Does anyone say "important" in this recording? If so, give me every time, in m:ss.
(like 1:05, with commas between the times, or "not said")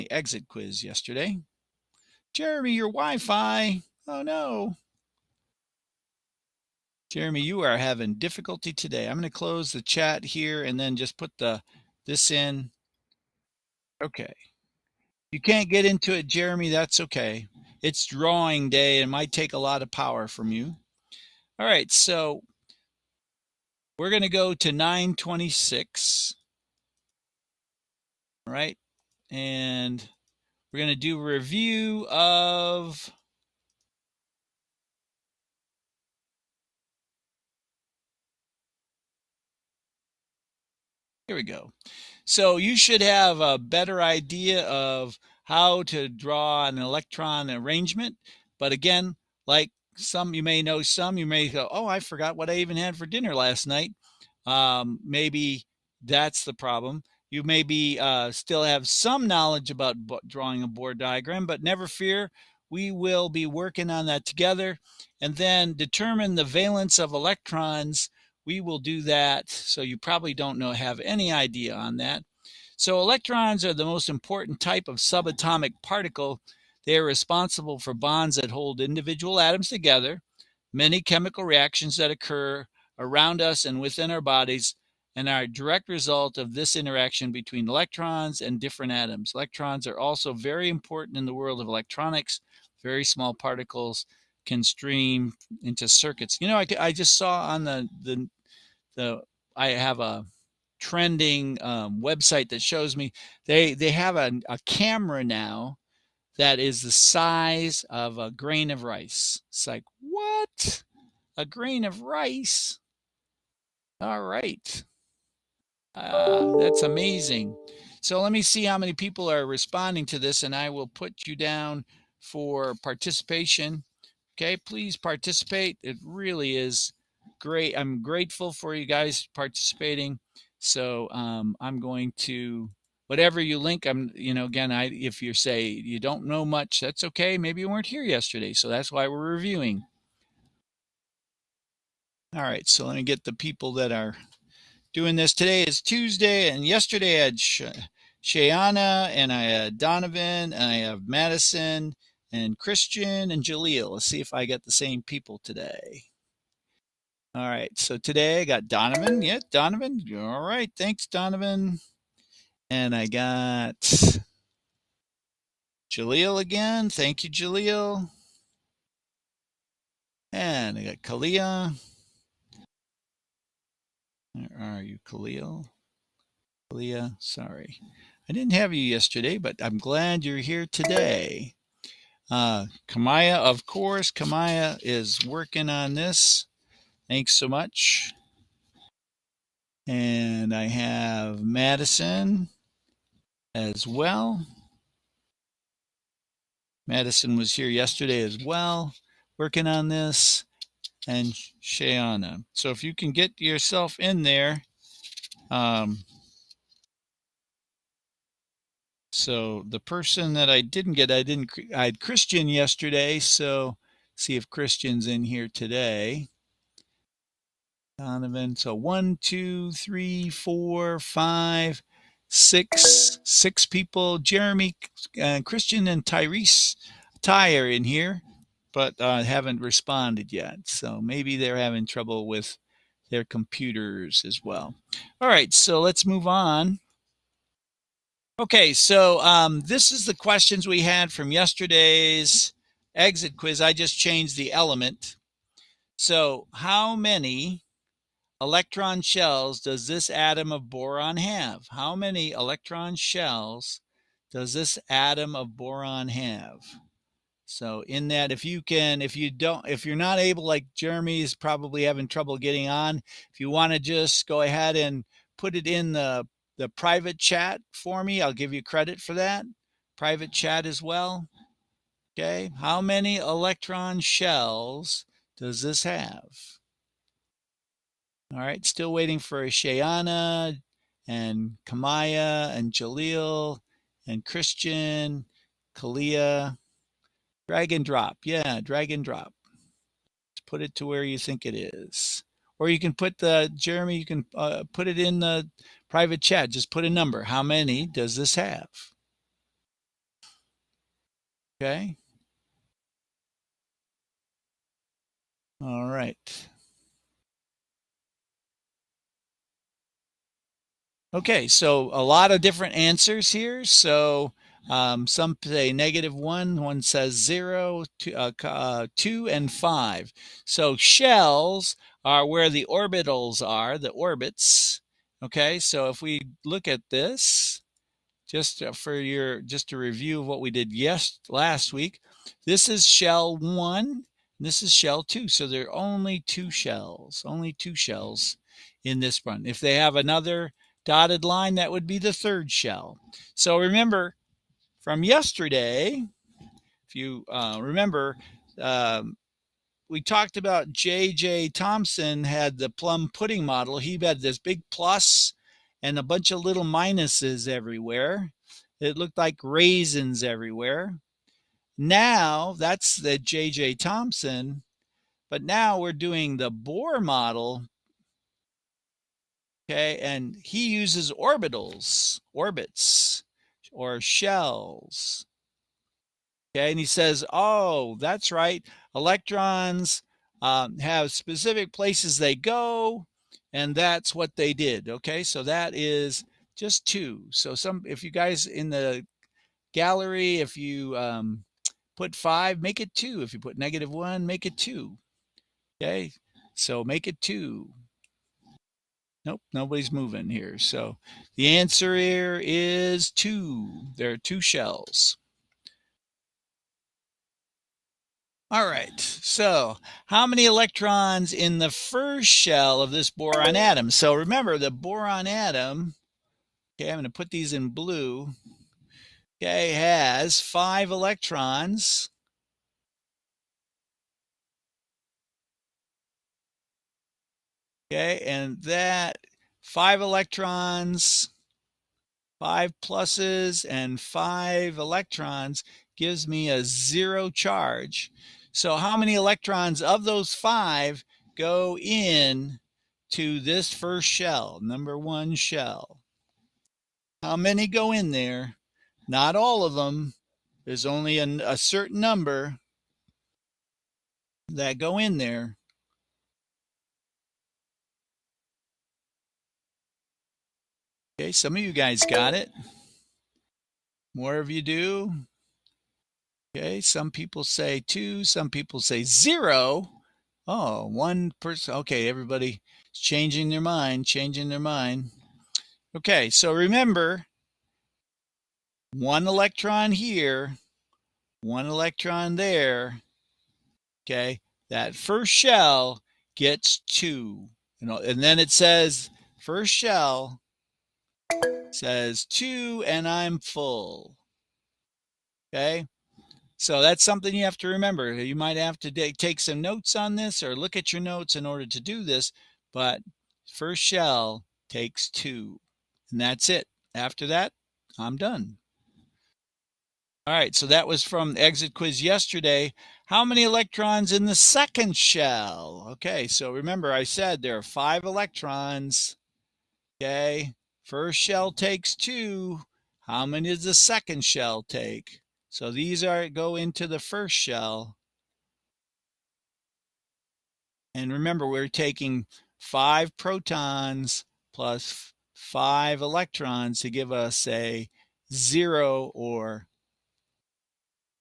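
1:14, 1:30.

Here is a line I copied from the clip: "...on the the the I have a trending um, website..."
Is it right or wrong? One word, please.
right.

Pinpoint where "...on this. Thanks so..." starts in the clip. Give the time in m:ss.
3:05.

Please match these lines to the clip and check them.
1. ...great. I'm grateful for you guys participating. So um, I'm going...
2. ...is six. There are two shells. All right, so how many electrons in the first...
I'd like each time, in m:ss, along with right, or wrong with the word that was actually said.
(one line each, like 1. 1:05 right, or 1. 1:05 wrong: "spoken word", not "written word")
1. 2:07 right
2. 6:42 wrong: "two", not "six".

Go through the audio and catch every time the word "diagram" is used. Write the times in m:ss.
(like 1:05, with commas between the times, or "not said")
1:00.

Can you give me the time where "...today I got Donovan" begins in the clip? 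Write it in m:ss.
2:37.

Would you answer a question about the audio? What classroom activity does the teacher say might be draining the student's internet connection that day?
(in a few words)
Drawing day.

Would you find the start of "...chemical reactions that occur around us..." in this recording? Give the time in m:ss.
1:21.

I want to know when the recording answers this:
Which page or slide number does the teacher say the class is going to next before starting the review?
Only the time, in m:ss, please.
0:24.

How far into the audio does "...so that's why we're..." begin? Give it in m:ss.
2:18.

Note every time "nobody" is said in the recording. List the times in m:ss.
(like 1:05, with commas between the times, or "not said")
6:39.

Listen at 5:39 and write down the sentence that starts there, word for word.
If they have another dotted line, that would be the third shell.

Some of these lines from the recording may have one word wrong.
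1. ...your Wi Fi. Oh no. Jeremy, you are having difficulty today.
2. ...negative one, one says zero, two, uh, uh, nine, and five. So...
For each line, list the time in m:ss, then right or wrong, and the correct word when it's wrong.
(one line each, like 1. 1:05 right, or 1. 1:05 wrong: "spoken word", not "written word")
1. 0:02 right
2. 5:15 wrong: "two", not "nine".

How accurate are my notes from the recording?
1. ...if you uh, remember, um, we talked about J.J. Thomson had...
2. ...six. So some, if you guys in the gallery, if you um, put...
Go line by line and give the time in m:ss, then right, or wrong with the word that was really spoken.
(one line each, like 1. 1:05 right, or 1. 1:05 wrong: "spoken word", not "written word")
1. 5:46 right
2. 6:26 wrong: "two", not "six".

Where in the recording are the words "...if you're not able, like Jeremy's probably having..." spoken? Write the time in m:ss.
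4:19.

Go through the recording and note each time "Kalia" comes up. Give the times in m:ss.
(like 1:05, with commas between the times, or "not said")
2:51, 2:56, 4:45.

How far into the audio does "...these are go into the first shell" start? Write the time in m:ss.
8:45.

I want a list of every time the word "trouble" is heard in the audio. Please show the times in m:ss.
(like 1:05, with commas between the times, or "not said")
3:51, 4:22.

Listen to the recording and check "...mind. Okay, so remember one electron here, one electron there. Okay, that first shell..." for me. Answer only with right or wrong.
right.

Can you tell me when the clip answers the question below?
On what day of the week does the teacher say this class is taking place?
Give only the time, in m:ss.
2:25.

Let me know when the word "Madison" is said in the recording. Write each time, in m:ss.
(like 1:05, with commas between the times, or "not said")
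2:31, 3:11, 3:16.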